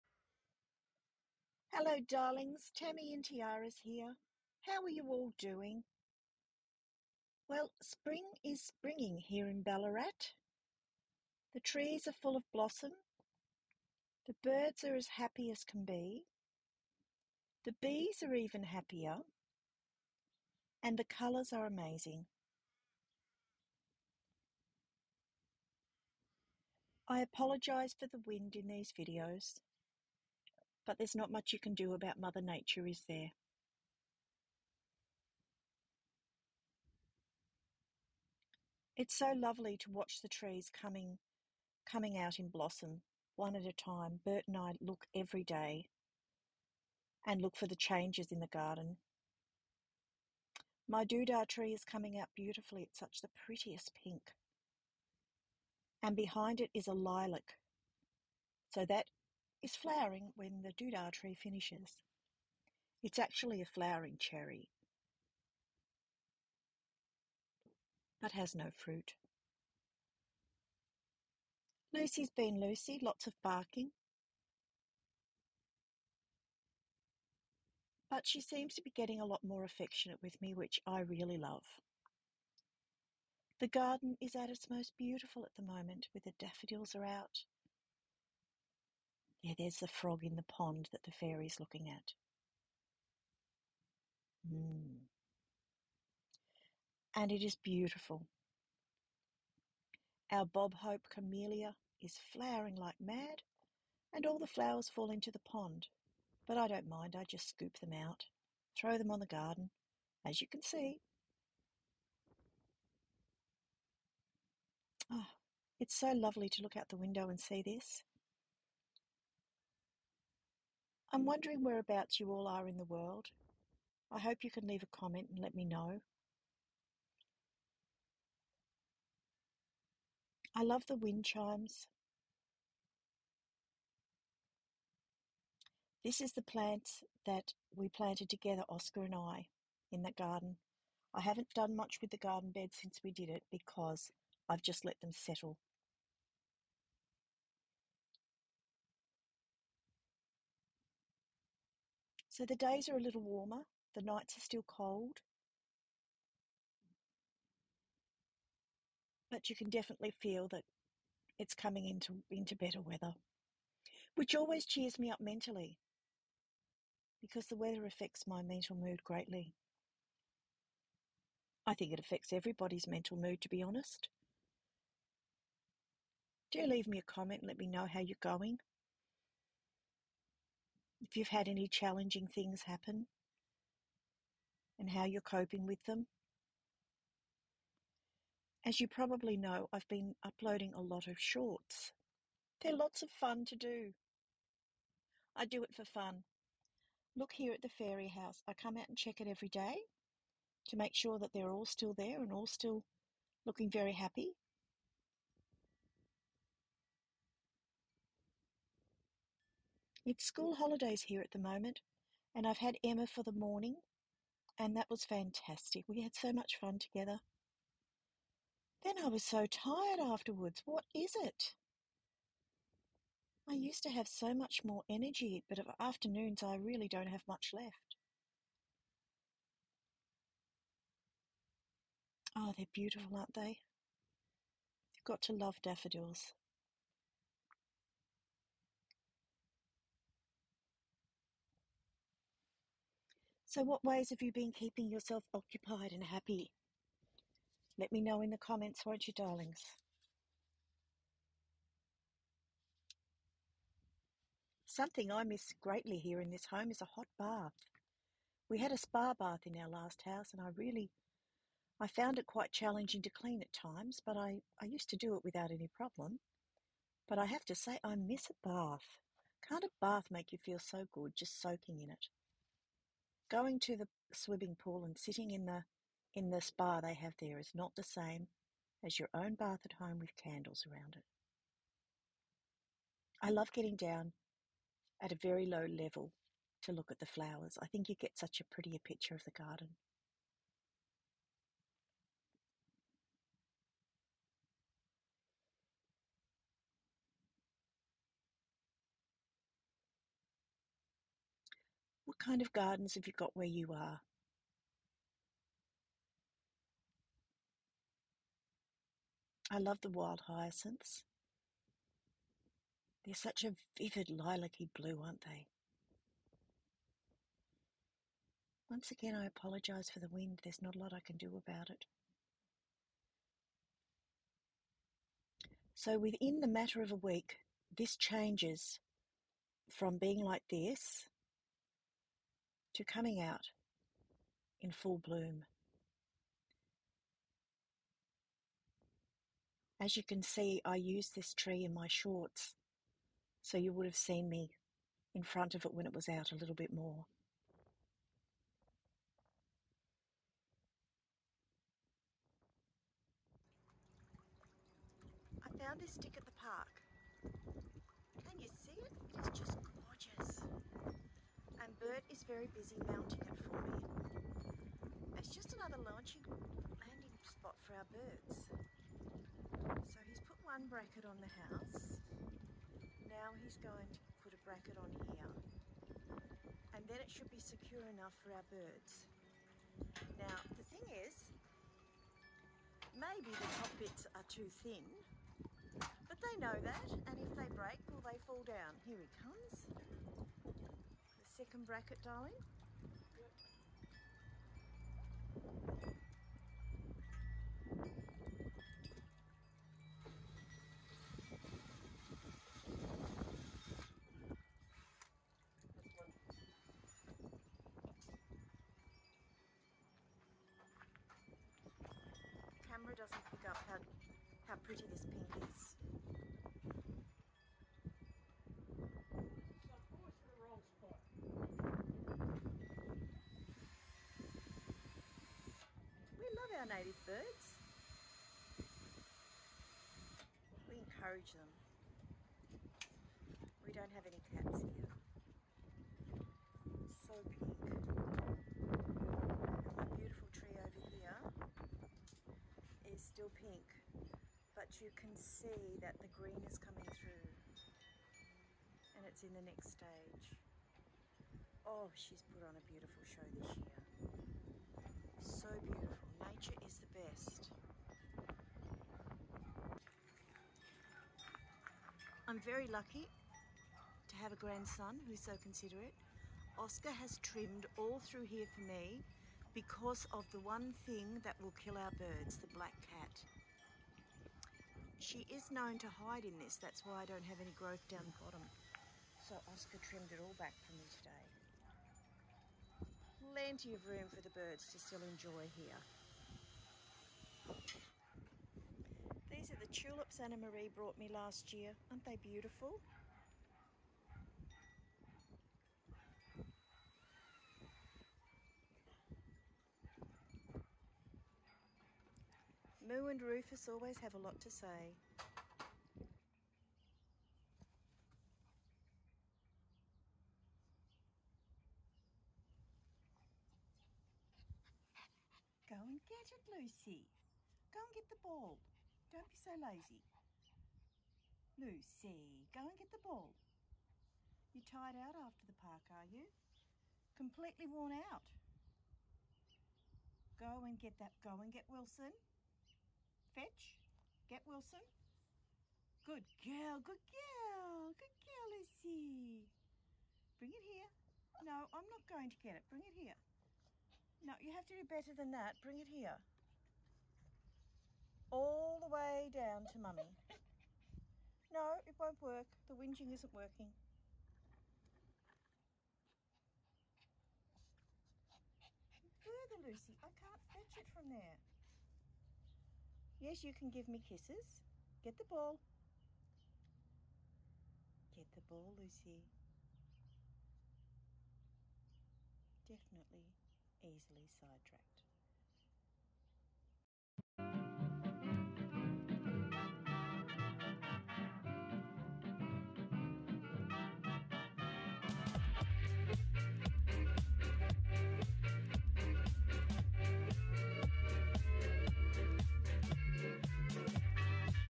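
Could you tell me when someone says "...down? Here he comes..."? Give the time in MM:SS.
06:28.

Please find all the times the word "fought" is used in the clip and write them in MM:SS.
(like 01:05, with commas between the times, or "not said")
not said.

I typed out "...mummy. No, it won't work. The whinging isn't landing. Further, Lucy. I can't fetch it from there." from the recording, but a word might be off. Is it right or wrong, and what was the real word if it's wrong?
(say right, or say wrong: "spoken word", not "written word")
wrong: "working", not "landing".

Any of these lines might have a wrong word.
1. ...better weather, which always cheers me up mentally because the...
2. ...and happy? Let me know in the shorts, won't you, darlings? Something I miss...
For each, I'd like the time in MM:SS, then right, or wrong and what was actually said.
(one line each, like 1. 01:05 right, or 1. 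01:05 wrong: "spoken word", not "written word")
1. 02:42 right
2. 04:05 wrong: "comments", not "shorts".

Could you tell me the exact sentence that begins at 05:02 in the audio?
kind of gardens have you got where you are?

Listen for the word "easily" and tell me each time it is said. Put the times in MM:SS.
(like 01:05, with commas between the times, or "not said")
09:33.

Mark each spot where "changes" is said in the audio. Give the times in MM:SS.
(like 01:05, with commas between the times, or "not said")
00:47, 05:27.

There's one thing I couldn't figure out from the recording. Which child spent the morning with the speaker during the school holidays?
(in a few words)
Emma.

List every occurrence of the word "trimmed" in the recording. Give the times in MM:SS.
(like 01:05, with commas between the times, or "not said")
07:47, 07:59.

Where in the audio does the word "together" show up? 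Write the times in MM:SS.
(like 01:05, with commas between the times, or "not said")
02:18, 03:36.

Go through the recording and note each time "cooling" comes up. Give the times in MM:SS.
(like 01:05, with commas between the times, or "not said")
not said.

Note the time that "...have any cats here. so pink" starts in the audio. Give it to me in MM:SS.
07:13.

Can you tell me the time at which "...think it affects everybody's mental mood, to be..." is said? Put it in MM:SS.
02:51.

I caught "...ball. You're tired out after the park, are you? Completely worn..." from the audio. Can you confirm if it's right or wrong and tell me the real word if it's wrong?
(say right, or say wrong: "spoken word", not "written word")
right.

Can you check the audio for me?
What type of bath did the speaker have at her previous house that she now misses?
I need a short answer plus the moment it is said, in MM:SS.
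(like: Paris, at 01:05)
Spa bath, at 04:18.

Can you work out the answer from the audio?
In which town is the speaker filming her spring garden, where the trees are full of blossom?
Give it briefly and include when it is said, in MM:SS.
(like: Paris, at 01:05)
Ballarat, at 00:09.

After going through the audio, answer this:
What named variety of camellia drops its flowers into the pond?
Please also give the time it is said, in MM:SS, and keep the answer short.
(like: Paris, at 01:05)
Bob Hope, at 01:40.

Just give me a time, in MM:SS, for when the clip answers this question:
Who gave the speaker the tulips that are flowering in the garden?
08:10.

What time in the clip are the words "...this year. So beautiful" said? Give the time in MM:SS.
07:33.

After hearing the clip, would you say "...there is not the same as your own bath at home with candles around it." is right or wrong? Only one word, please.
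right.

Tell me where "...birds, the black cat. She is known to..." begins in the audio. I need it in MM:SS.
07:51.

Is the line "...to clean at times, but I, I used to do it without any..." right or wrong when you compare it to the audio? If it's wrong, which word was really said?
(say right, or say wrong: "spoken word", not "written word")
right.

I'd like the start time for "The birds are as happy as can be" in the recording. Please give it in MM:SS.
00:14.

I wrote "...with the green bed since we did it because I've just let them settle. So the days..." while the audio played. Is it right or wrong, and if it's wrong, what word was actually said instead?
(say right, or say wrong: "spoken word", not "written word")
wrong: "garden", not "green".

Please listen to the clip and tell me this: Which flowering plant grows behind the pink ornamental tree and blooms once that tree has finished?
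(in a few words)
Lilac.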